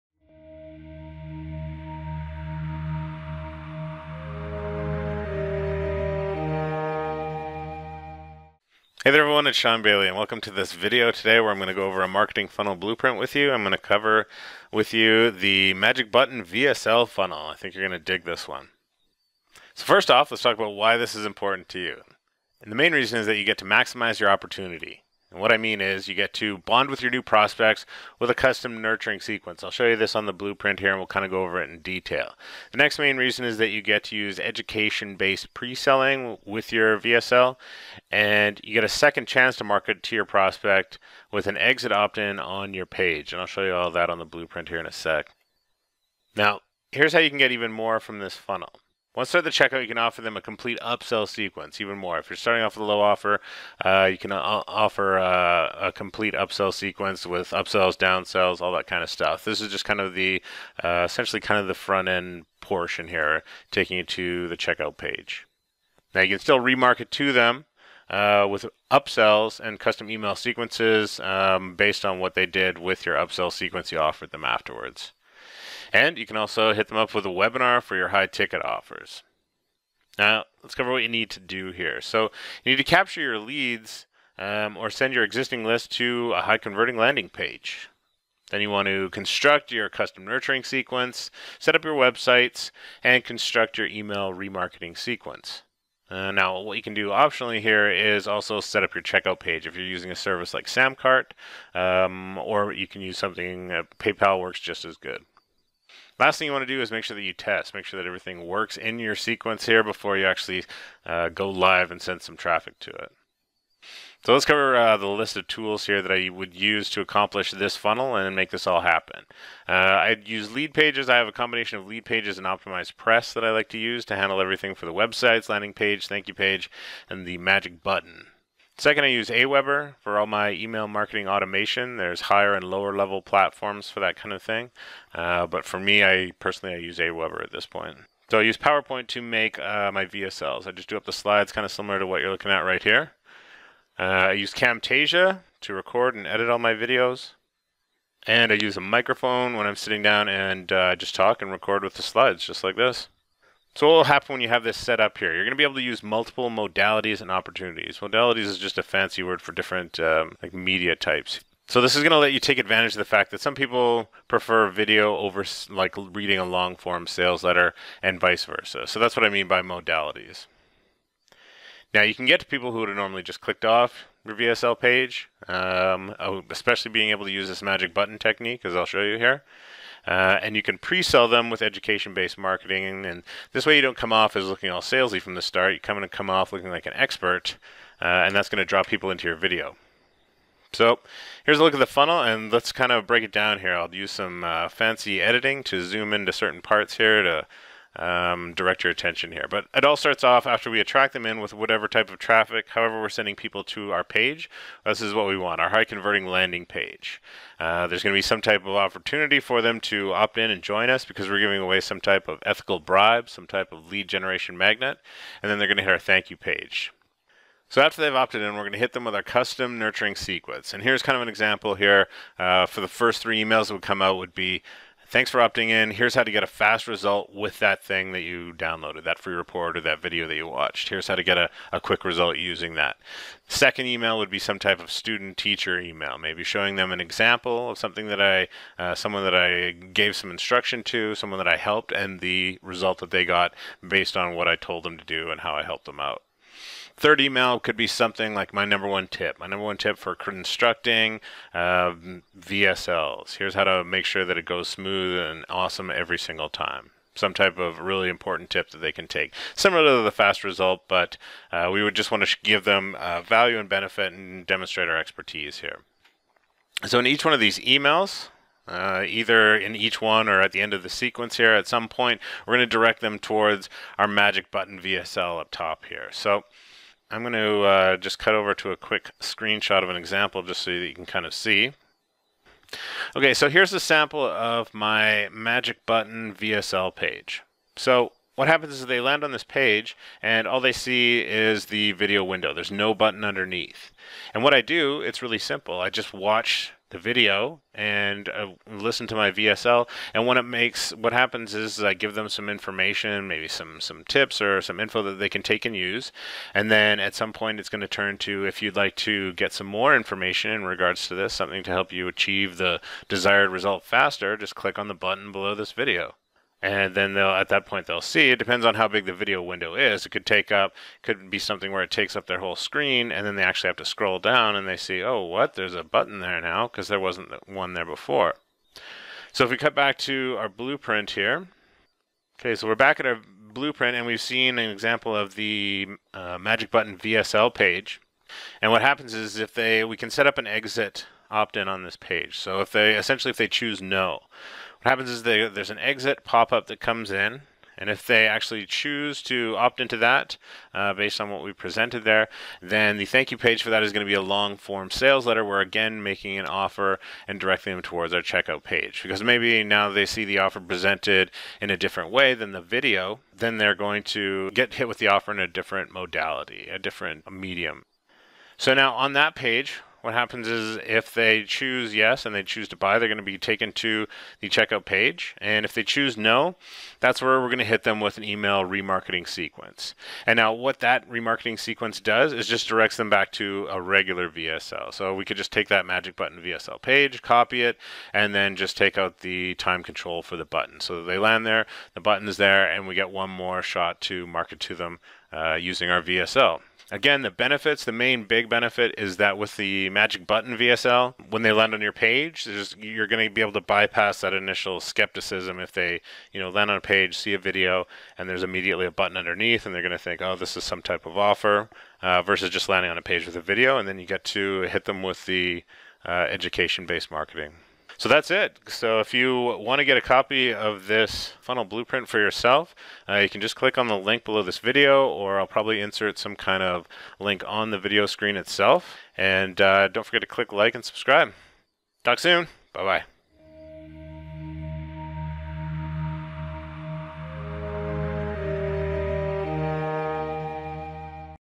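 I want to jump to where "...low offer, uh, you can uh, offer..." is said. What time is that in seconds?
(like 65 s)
52 s.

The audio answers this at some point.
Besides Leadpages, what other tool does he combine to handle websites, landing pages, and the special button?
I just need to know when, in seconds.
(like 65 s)
122 s.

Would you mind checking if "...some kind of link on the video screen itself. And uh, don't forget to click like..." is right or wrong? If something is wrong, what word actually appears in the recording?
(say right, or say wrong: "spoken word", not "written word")
right.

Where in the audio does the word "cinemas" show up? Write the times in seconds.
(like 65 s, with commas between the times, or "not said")
not said.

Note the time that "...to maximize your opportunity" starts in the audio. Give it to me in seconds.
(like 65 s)
23 s.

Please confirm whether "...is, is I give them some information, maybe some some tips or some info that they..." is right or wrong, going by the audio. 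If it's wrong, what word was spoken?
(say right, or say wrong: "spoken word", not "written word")
right.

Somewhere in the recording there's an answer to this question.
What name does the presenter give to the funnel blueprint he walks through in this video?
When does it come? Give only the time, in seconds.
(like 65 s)
15 s.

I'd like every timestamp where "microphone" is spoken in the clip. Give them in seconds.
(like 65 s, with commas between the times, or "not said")
148 s.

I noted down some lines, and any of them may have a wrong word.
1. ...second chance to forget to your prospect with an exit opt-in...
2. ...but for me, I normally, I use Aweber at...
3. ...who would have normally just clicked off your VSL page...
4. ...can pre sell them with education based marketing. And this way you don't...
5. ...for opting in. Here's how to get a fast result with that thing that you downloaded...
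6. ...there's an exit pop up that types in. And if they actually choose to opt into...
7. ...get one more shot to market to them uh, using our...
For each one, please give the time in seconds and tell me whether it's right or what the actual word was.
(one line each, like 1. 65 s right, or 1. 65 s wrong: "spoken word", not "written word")
1. 38 s wrong: "market", not "forget"
2. 135 s wrong: "personally", not "normally"
3. 172 s right
4. 180 s right
5. 225 s right
6. 345 s wrong: "comes", not "types"
7. 392 s right.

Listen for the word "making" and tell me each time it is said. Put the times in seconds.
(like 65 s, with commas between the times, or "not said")
356 s.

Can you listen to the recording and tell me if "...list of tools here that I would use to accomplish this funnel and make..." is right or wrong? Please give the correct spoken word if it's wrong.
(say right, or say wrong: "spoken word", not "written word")
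right.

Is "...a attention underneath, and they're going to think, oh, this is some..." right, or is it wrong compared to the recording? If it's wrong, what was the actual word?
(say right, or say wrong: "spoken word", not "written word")
wrong: "button", not "attention".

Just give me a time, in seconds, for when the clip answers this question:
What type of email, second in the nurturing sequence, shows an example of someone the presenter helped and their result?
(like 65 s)
234 s.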